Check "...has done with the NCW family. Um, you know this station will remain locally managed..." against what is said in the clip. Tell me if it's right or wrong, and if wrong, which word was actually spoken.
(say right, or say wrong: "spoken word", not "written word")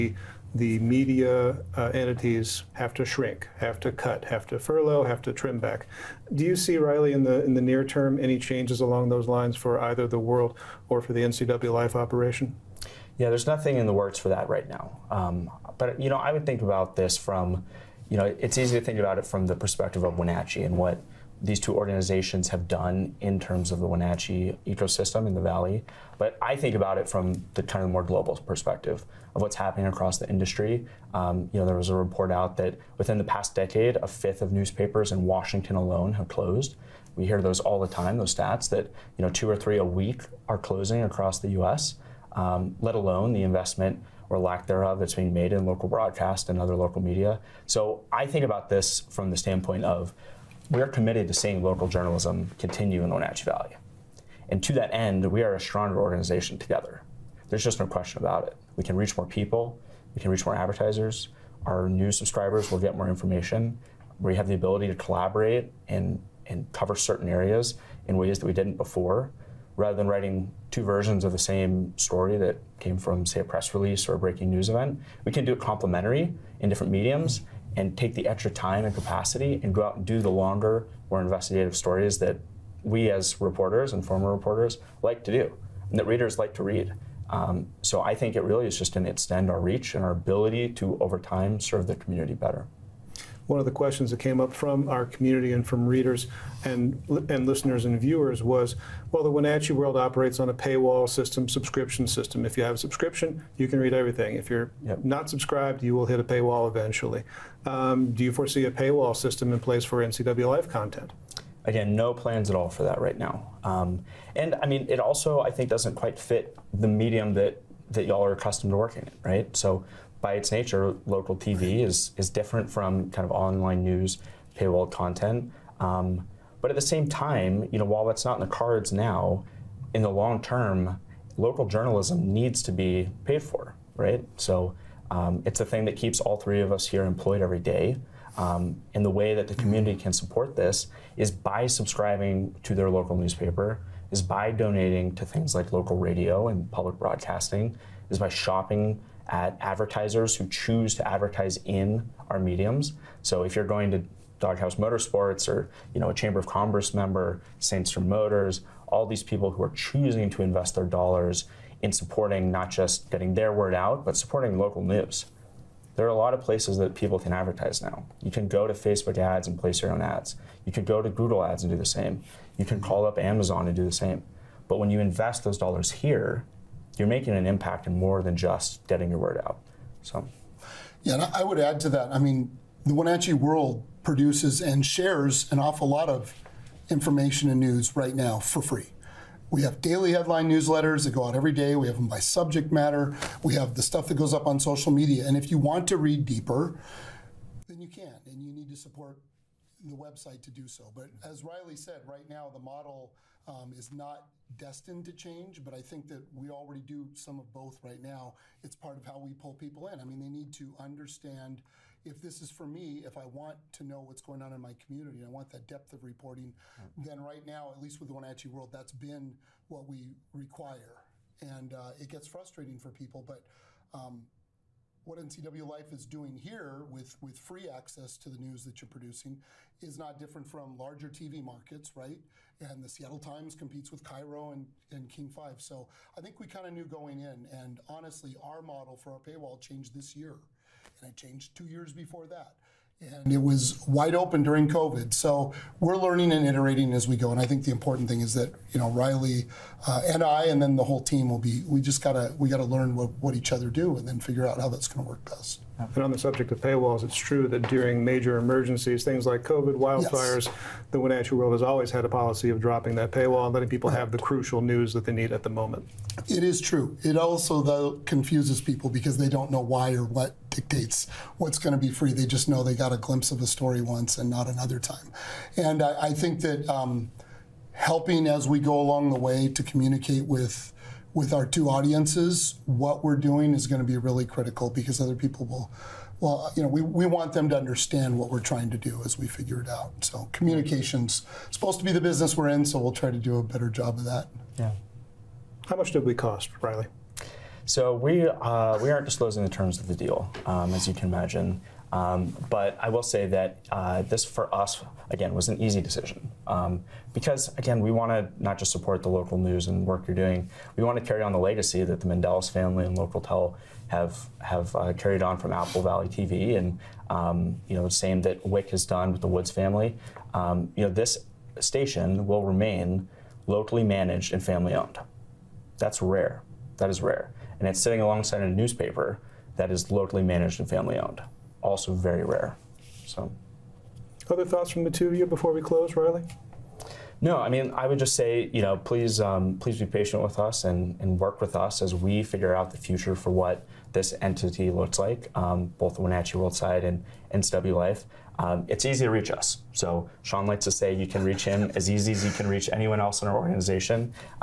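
wrong: "Woods", not "NCW".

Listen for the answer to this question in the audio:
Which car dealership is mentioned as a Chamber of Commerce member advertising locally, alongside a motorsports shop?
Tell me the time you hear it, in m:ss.
2:37.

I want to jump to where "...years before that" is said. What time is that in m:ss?
4:01.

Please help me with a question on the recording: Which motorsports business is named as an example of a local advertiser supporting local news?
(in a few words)
Doghouse Motorsports.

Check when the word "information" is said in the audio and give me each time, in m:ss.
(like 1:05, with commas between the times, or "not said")
1:03, 3:06.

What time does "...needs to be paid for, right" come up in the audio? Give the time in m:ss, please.
2:12.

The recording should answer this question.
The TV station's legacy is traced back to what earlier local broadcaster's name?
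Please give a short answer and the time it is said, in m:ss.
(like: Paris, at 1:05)
Apple Valley TV, at 5:15.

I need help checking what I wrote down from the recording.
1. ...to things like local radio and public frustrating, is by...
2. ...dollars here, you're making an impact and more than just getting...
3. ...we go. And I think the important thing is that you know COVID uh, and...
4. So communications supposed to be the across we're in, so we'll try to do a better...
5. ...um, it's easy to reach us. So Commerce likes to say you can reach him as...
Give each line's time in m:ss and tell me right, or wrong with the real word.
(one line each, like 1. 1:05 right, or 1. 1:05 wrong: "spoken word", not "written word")
1. 2:25 wrong: "broadcasting", not "frustrating"
2. 2:55 right
3. 4:07 wrong: "Riley", not "COVID"
4. 4:50 wrong: "business", not "across"
5. 5:48 wrong: "Sean", not "Commerce".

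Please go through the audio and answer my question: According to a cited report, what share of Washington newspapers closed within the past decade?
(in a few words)
a fifth.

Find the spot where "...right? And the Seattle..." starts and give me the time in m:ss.
3:51.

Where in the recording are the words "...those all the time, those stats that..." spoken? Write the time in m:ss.
0:37.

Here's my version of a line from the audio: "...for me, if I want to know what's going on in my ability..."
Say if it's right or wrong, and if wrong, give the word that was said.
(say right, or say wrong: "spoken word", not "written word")
wrong: "community", not "ability".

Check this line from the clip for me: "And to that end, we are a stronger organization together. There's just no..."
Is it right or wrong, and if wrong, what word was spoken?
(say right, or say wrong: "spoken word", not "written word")
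right.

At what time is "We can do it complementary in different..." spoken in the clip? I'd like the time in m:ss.
1:15.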